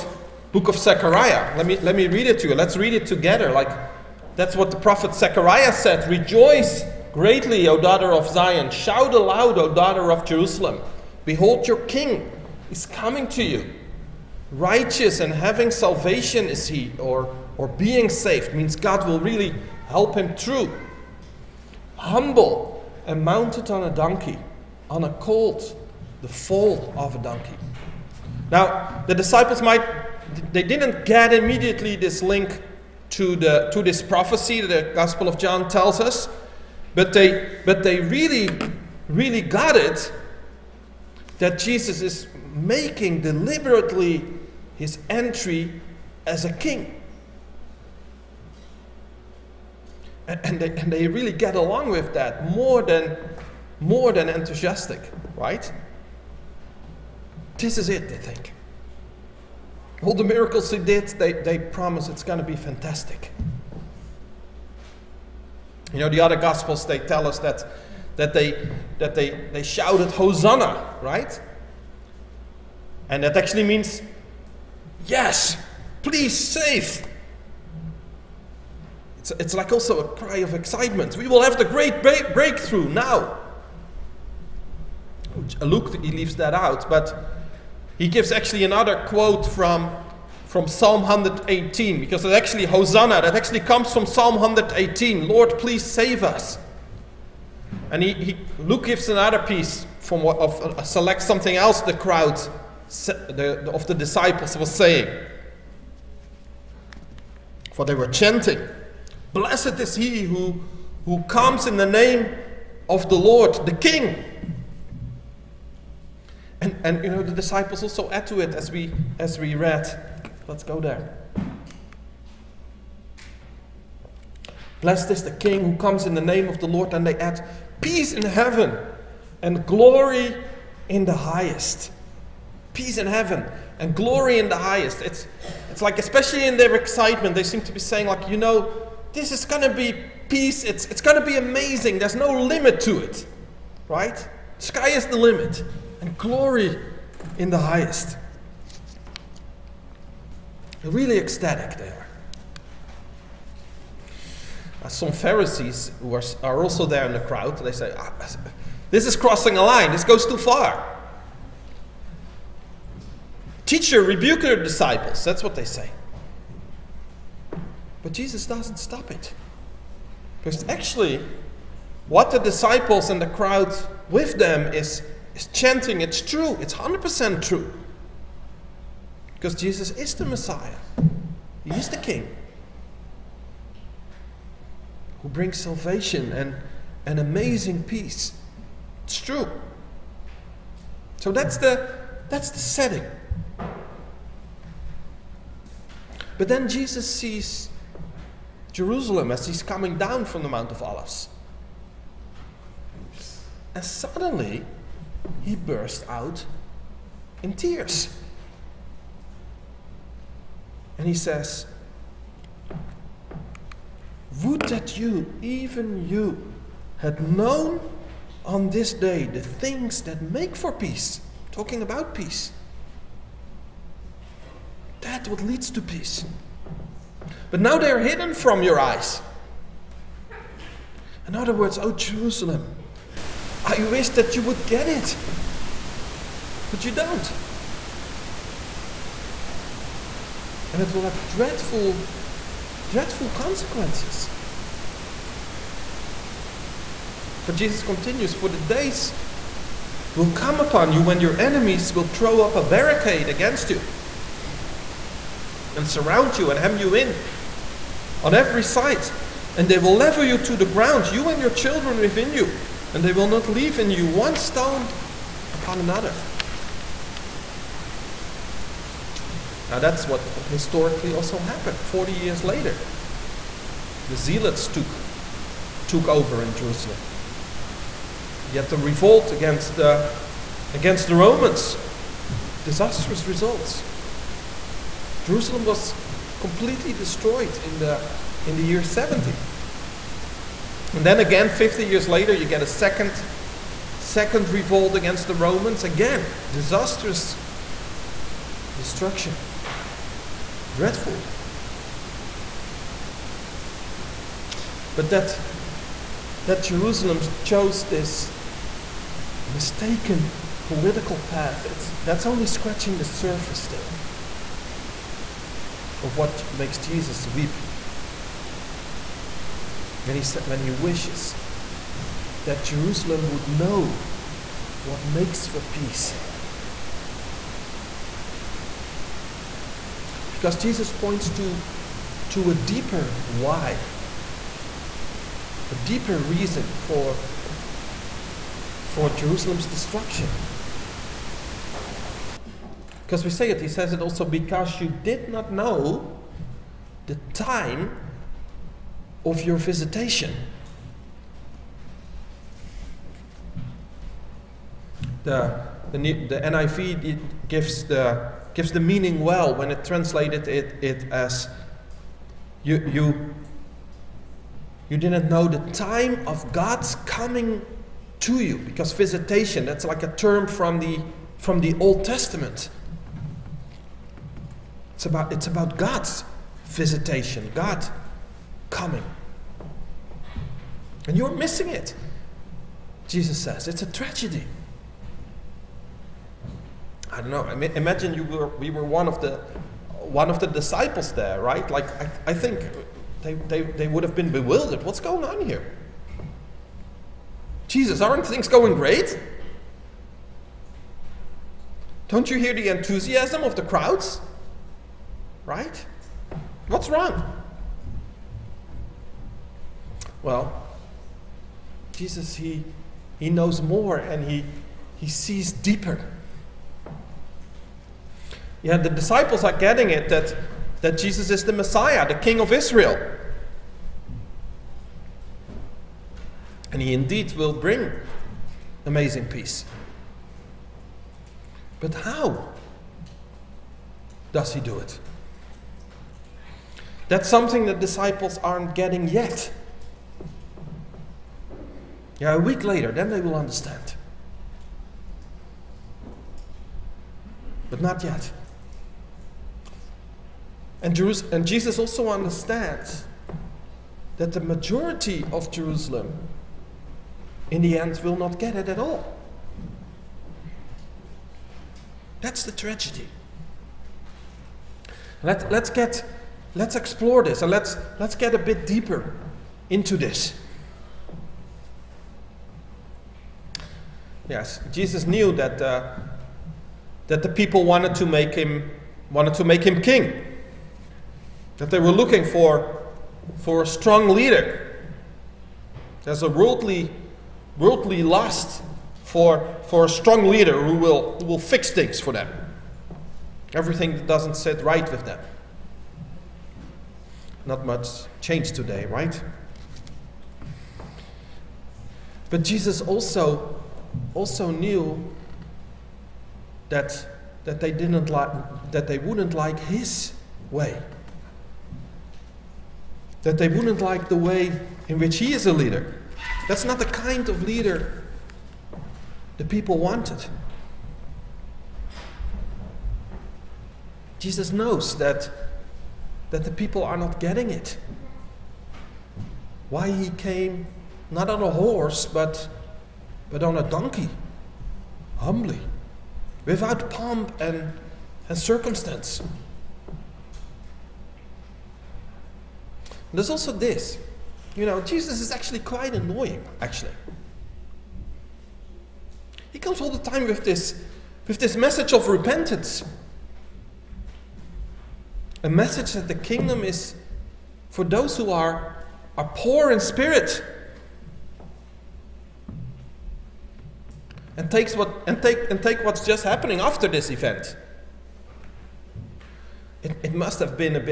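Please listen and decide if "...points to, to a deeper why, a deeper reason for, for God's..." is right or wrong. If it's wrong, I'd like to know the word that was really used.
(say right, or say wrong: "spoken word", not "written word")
wrong: "Jerusalem", not "God".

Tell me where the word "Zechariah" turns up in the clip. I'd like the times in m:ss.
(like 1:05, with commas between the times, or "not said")
0:00, 0:05.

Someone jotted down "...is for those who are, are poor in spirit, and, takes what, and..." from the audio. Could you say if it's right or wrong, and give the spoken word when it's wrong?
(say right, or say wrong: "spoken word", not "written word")
right.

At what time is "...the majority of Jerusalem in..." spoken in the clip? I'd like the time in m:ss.
7:34.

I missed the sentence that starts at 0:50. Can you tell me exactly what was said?
And, and, they, and they really get along with that more than, more than enthusiastic, right?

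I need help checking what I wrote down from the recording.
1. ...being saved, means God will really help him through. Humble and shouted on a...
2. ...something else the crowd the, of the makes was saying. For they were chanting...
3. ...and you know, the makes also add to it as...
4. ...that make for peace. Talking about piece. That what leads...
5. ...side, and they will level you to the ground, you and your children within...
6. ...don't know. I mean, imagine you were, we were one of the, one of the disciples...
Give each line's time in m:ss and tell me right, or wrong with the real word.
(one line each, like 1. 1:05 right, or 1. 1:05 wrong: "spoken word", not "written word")
1. 0:17 wrong: "mounted", not "shouted"
2. 1:41 wrong: "disciples", not "makes"
3. 1:56 wrong: "disciples", not "makes"
4. 3:40 wrong: "peace", not "piece"
5. 4:18 right
6. 6:27 right.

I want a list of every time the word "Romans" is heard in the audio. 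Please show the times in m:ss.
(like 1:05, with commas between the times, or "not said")
4:41, 4:55.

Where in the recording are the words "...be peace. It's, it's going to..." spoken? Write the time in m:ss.
2:19.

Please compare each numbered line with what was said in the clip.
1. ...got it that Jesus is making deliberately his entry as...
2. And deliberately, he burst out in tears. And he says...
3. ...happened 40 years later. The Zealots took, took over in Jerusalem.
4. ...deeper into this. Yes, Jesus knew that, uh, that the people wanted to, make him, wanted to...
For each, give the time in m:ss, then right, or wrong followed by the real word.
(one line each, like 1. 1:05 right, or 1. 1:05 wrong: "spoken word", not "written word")
1. 0:39 right
2. 3:23 wrong: "suddenly", not "deliberately"
3. 4:31 right
4. 7:48 right.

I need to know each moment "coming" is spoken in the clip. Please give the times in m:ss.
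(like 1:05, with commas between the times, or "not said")
0:12, 3:19, 6:07, 6:18.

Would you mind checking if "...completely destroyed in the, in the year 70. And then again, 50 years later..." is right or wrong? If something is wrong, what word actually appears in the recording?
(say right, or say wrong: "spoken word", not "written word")
right.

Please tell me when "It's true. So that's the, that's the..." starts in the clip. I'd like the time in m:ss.
3:09.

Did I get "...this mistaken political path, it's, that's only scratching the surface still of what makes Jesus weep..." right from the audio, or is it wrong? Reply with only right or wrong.
right.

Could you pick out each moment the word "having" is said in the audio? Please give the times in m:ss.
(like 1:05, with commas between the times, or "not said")
0:15.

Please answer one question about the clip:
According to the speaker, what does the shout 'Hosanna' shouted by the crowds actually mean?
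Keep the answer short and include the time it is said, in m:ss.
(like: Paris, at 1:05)
Yes, please save, at 1:15.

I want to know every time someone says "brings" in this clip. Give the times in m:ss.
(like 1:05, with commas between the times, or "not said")
3:05, 7:07.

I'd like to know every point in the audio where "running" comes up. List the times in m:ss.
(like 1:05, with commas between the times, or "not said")
not said.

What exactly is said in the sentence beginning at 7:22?
Yeah, a week later, then they will understand.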